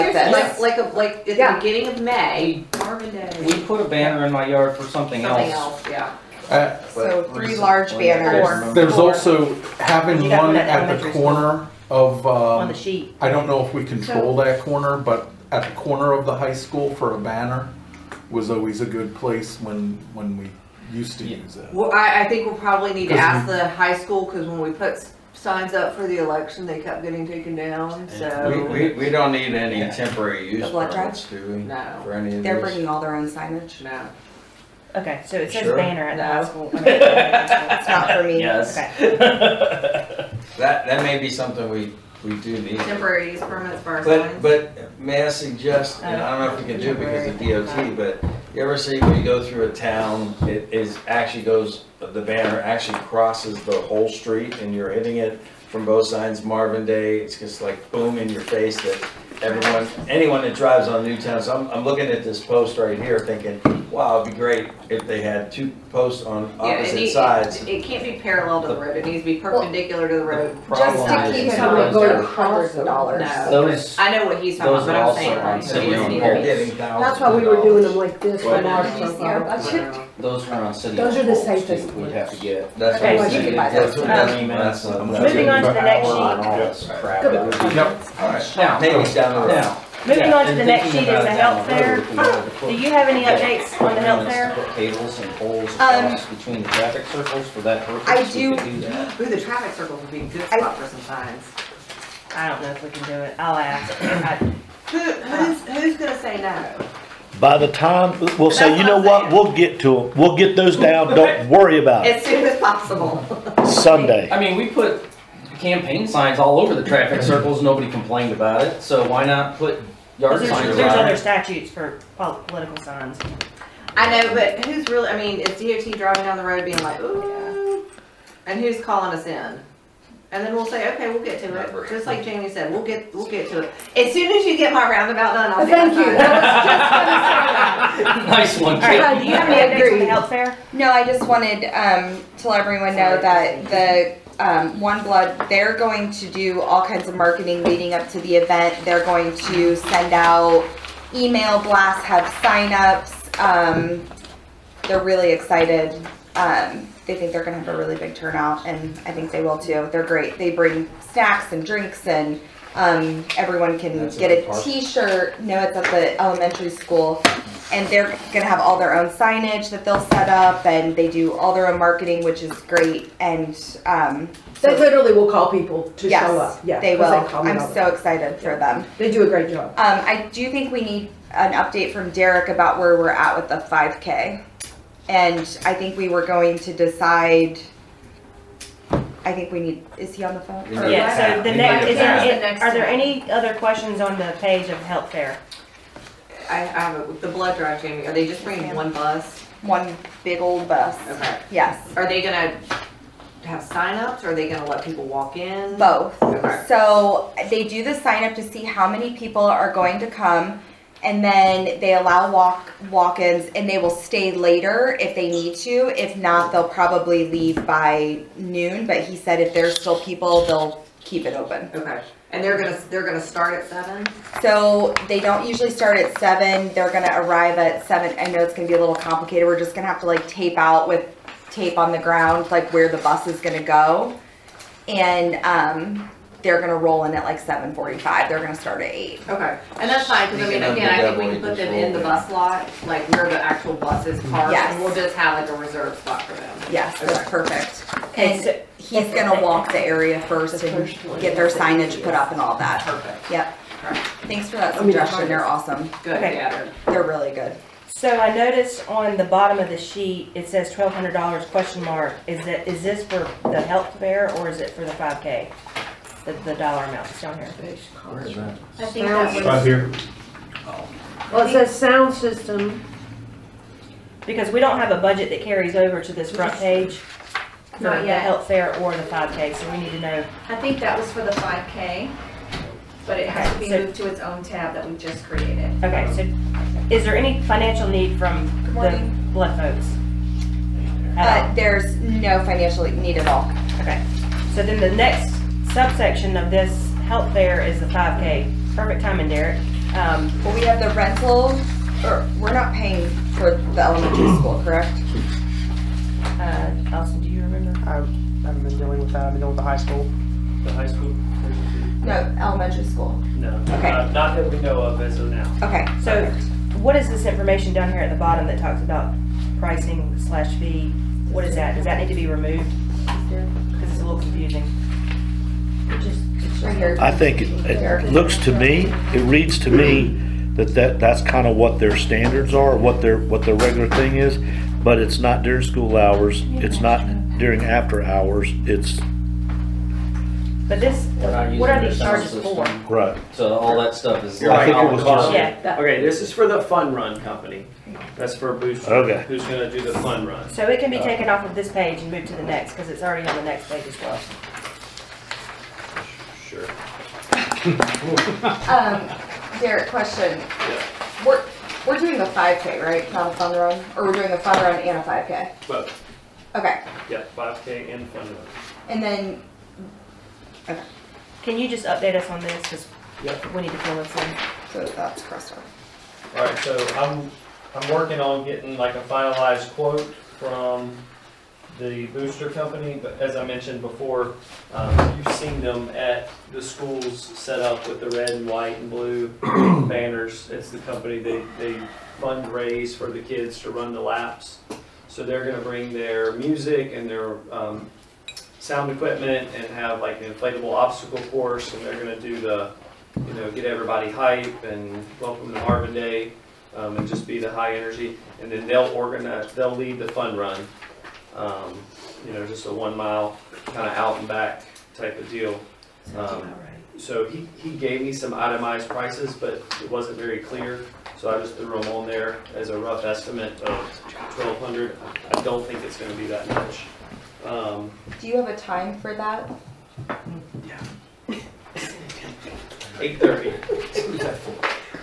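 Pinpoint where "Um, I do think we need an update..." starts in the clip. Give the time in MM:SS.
02:59.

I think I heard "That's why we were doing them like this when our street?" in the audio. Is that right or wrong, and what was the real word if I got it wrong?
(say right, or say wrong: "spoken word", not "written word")
wrong: "budget", not "street".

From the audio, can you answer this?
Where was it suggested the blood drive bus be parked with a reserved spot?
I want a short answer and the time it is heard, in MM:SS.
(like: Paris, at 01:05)
the bus lot, at 04:01.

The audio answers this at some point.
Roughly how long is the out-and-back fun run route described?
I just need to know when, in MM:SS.
06:52.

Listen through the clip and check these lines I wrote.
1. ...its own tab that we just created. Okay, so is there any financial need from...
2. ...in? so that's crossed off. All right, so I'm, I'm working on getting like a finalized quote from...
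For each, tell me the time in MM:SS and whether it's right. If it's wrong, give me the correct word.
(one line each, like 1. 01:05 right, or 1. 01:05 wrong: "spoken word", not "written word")
1. 04:44 right
2. 06:14 right.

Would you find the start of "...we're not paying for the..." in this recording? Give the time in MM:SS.
05:02.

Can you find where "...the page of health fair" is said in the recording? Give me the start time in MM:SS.
03:14.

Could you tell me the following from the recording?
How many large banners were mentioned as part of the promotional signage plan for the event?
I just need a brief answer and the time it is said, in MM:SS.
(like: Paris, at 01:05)
3, at 00:07.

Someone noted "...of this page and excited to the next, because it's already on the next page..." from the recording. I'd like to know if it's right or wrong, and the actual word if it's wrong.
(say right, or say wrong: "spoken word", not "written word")
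wrong: "moved", not "excited".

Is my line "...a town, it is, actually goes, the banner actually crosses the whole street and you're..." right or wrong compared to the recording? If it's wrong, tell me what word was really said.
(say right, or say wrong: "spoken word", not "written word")
right.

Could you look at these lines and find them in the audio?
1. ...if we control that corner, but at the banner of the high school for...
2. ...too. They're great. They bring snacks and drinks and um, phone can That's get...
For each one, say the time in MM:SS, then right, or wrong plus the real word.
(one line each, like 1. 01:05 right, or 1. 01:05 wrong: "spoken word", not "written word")
1. 00:13 wrong: "corner", not "banner"
2. 02:39 wrong: "everyone", not "phone".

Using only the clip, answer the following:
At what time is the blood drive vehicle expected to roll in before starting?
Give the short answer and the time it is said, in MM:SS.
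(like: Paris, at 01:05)
7:45, at 03:57.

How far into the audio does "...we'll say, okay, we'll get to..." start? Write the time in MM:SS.
02:10.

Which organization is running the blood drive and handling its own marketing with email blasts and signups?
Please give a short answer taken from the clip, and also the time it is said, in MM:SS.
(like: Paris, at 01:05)
OneBlood, at 02:24.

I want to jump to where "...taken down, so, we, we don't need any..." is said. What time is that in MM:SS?
00:27.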